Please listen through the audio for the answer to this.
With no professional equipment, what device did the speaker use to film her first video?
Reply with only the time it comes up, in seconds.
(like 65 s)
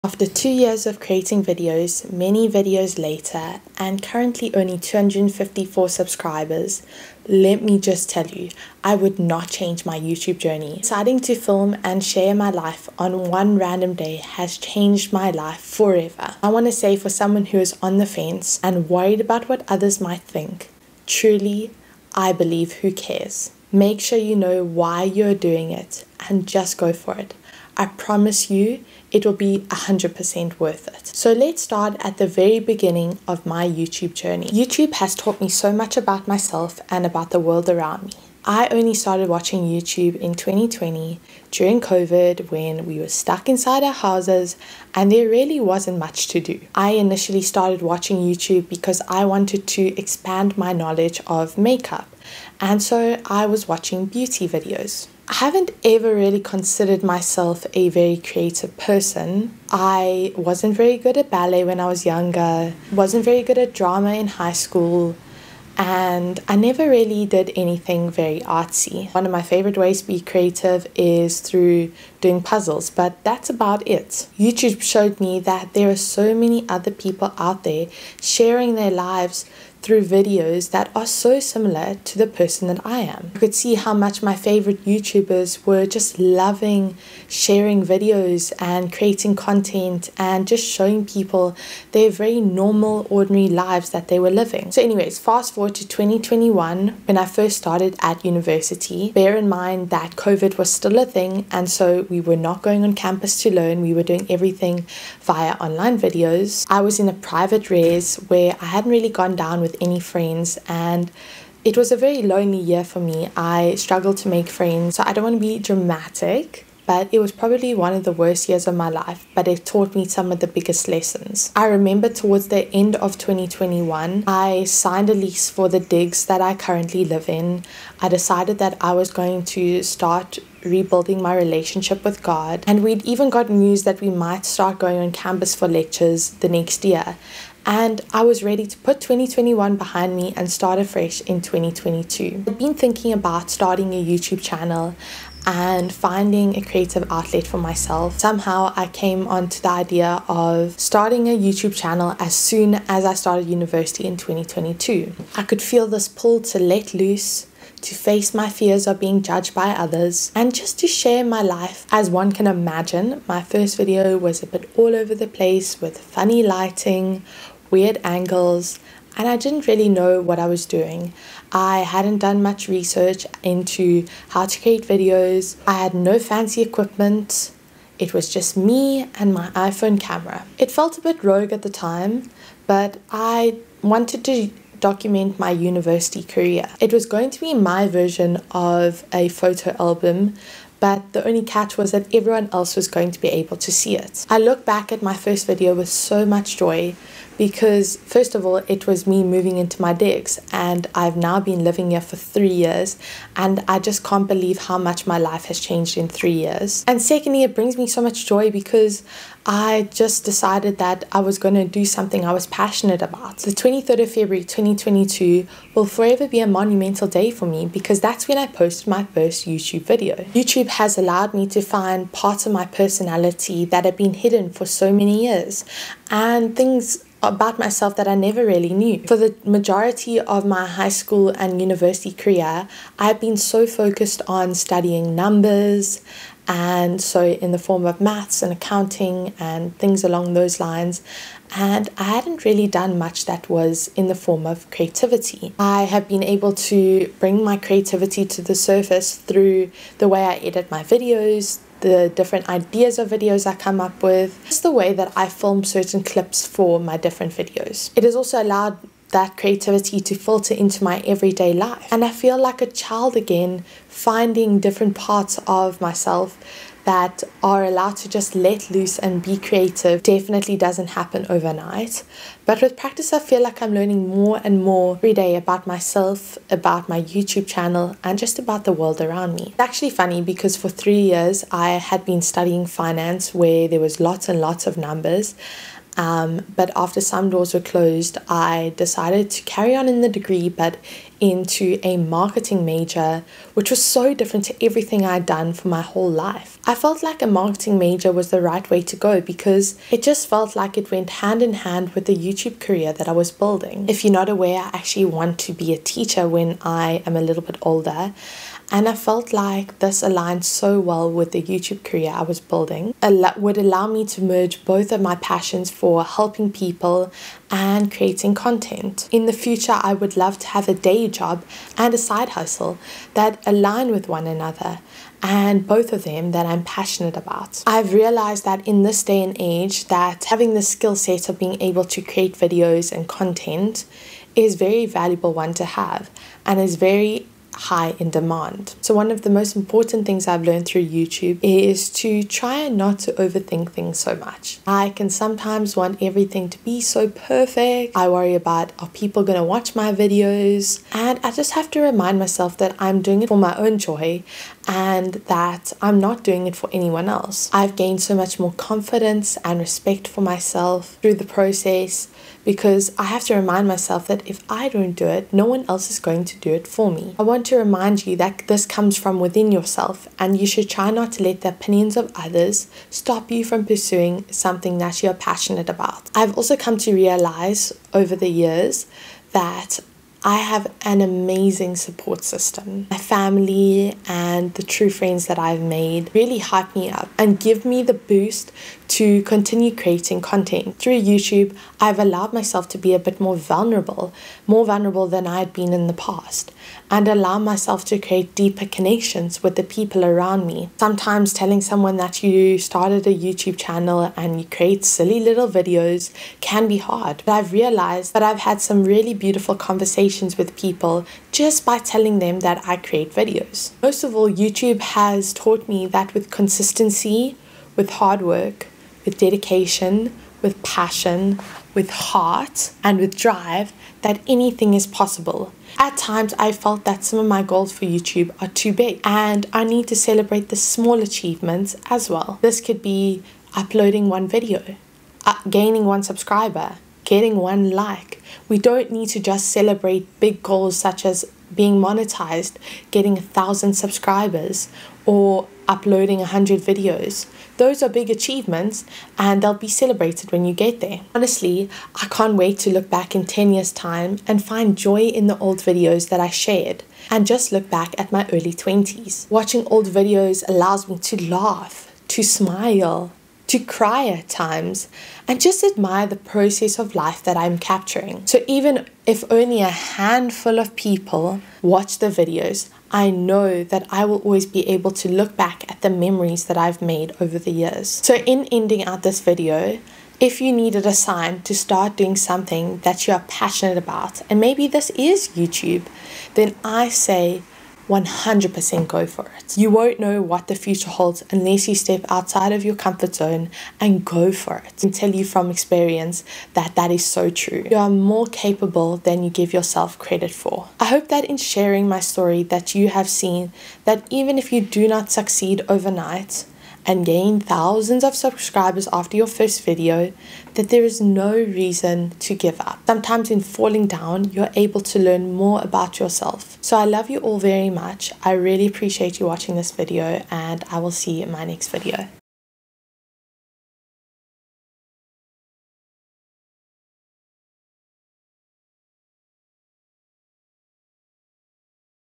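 179 s.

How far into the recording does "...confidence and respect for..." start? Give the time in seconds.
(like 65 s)
358 s.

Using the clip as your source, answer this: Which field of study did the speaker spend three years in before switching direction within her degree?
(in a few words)
finance.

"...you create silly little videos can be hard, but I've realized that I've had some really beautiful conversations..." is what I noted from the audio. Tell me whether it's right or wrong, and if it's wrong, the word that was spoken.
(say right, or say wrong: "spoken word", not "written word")
right.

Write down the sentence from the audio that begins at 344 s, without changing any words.
I can sometimes want everything to be so perfect.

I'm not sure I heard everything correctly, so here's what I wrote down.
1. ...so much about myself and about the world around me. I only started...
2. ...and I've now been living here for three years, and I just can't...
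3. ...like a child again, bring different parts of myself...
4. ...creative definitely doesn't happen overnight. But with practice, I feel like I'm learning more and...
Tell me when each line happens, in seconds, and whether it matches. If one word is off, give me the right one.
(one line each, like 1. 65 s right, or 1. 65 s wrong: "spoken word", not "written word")
1. 35 s right
2. 200 s right
3. 262 s wrong: "finding", not "bring"
4. 269 s right.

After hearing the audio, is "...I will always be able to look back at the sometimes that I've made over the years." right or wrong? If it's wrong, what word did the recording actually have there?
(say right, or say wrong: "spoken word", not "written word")
wrong: "memories", not "sometimes".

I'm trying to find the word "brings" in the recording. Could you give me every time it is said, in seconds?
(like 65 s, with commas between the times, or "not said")
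207 s, 247 s.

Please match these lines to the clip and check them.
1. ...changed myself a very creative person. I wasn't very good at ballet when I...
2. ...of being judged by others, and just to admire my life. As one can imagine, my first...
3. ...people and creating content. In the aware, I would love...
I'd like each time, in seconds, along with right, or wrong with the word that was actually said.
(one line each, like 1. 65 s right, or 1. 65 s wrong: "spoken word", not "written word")
1. 56 s wrong: "considered", not "changed"
2. 158 s wrong: "share", not "admire"
3. 316 s wrong: "future", not "aware".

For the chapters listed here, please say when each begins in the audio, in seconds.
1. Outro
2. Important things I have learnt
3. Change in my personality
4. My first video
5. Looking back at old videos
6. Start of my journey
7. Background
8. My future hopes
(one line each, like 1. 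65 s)
1. 501 s
2. 328 s
3. 220 s
4. 162 s
5. 451 s
6. 94 s
7. 32 s
8. 280 s.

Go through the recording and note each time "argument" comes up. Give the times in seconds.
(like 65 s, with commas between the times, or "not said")
not said.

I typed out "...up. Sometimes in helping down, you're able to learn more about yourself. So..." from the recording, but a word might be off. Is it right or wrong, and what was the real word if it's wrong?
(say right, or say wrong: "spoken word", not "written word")
wrong: "falling", not "helping".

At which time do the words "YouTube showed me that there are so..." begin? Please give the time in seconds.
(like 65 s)
74 s.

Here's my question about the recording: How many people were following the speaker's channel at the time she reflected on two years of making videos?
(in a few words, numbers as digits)
254.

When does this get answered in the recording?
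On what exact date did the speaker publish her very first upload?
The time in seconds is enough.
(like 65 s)
213 s.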